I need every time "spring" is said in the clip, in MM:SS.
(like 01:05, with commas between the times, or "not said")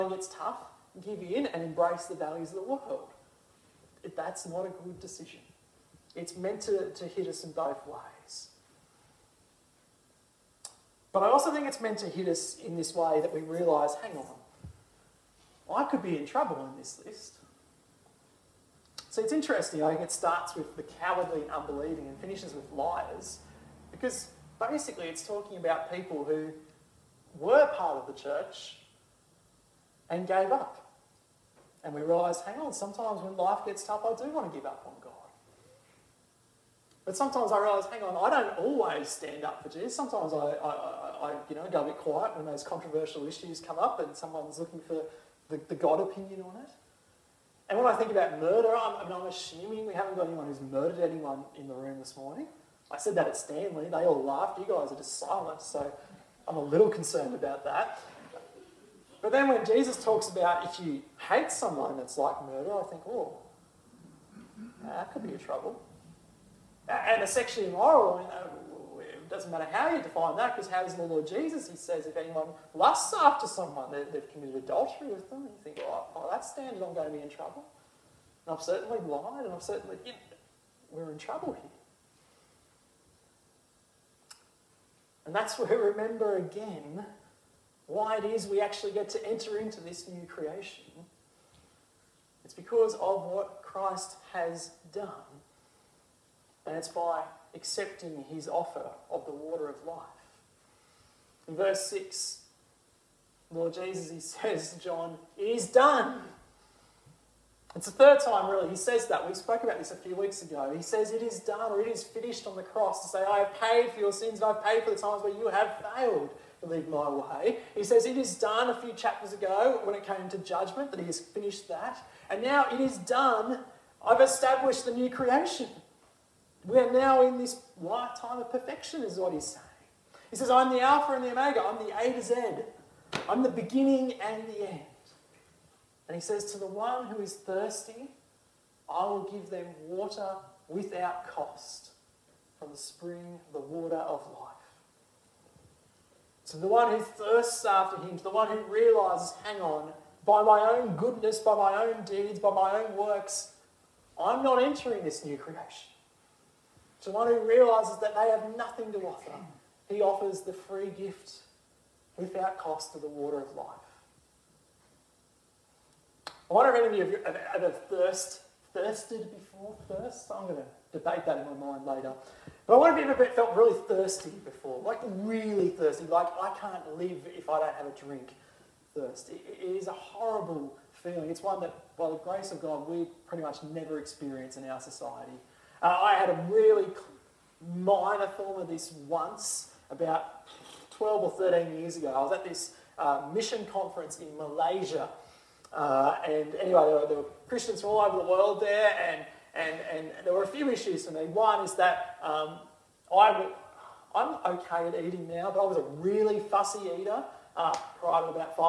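02:22.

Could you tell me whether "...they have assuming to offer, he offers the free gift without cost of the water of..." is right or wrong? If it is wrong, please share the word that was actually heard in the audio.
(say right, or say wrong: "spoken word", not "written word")
wrong: "nothing", not "assuming".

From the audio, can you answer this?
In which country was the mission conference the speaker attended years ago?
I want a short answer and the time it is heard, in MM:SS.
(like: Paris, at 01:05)
Malaysia, at 03:14.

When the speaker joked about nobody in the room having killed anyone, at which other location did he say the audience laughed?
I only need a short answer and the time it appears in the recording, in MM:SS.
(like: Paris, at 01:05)
Stanley, at 00:53.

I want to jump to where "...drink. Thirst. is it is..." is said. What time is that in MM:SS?
02:58.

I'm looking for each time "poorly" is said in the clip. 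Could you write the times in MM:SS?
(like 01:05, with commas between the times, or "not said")
not said.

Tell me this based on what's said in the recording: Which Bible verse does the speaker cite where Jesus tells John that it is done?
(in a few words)
Verse 6.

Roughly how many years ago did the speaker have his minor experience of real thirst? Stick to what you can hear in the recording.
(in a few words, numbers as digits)
12 or 13.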